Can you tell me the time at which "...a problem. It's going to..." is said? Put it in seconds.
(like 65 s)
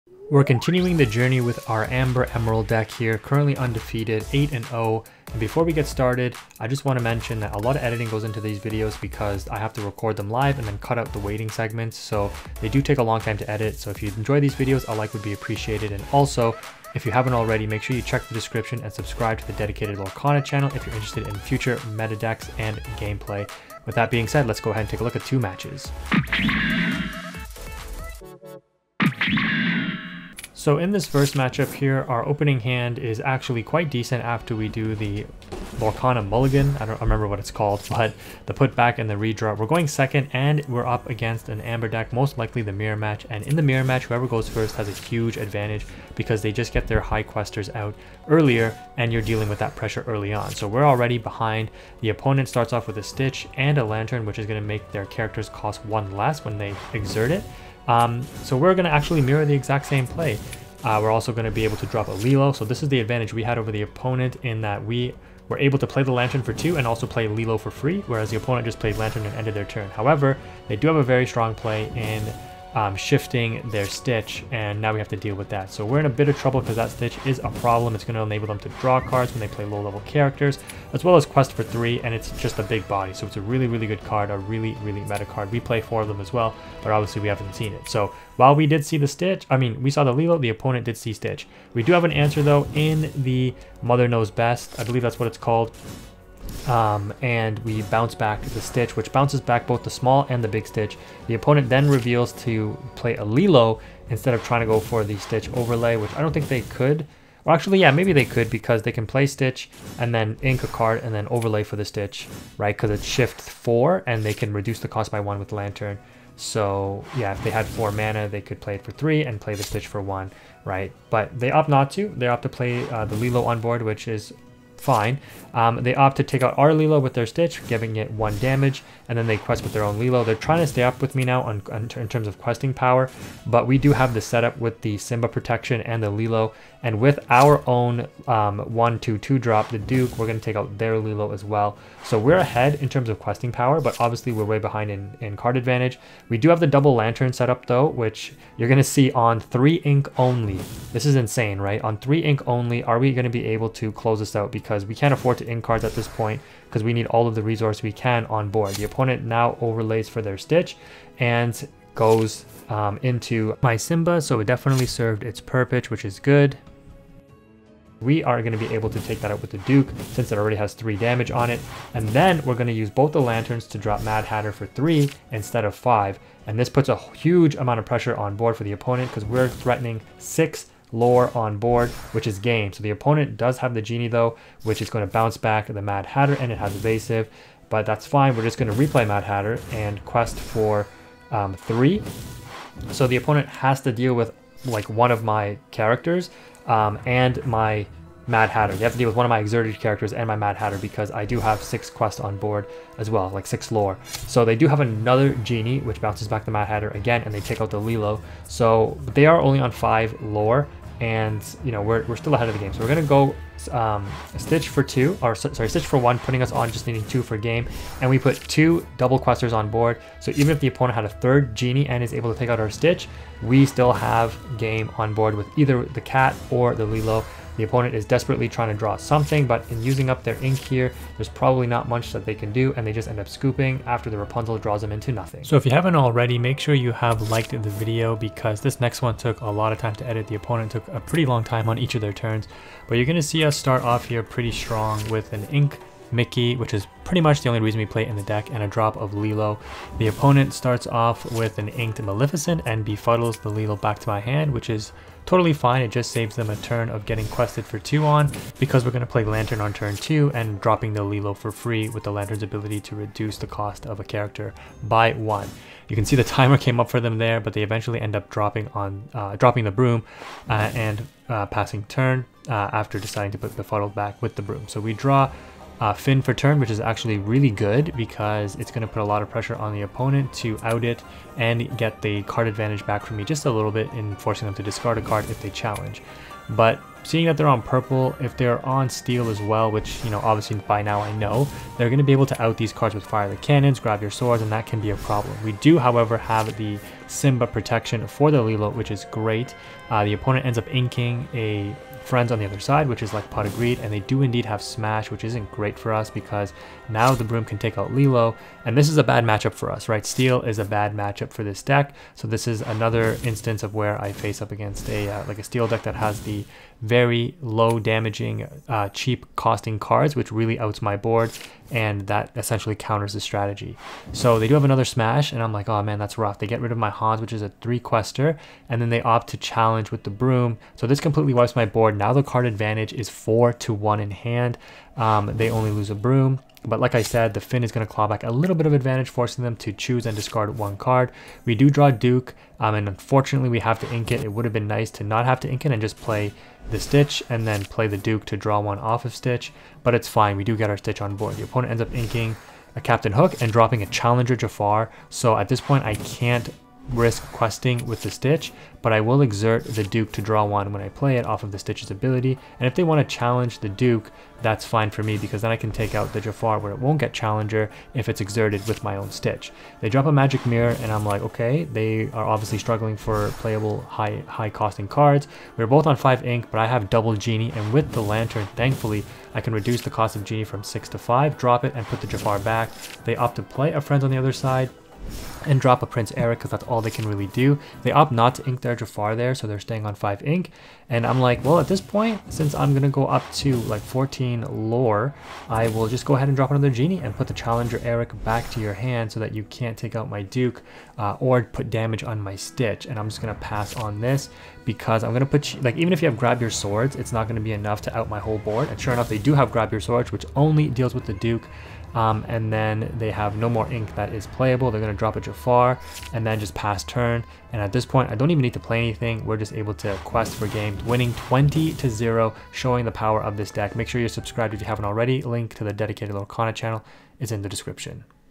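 77 s.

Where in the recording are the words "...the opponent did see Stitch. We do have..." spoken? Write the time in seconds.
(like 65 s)
90 s.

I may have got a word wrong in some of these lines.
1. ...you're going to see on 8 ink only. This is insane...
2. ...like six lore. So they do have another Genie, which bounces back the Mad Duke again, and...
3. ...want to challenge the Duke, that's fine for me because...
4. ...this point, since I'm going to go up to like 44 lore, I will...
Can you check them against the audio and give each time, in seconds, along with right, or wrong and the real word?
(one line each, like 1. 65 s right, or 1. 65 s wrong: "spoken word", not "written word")
1. 148 s wrong: "3", not "8"
2. 203 s wrong: "Hatter", not "Duke"
3. 362 s right
4. 391 s wrong: "14", not "44".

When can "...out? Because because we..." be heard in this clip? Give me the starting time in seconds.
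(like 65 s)
154 s.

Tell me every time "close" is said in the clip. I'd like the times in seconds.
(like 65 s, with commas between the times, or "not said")
153 s.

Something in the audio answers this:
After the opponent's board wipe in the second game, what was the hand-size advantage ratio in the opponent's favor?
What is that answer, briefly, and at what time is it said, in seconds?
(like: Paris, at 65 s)
4 to 1, at 333 s.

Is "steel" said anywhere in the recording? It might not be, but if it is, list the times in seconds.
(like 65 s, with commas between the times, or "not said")
288 s, 310 s, 315 s.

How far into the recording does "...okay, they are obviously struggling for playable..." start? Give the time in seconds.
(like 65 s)
371 s.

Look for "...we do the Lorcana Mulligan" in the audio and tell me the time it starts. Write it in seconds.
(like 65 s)
34 s.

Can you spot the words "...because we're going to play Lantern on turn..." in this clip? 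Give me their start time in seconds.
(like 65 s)
258 s.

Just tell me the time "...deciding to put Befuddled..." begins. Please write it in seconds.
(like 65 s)
272 s.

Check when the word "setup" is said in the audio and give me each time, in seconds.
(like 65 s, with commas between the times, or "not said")
134 s, 147 s.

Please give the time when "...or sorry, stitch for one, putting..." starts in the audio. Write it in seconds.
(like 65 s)
215 s.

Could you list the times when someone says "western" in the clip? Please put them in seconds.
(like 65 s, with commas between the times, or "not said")
not said.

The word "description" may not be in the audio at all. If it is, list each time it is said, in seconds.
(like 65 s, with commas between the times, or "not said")
18 s, 427 s.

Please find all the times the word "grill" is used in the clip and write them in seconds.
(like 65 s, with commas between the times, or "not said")
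not said.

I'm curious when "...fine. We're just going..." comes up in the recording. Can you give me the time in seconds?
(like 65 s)
188 s.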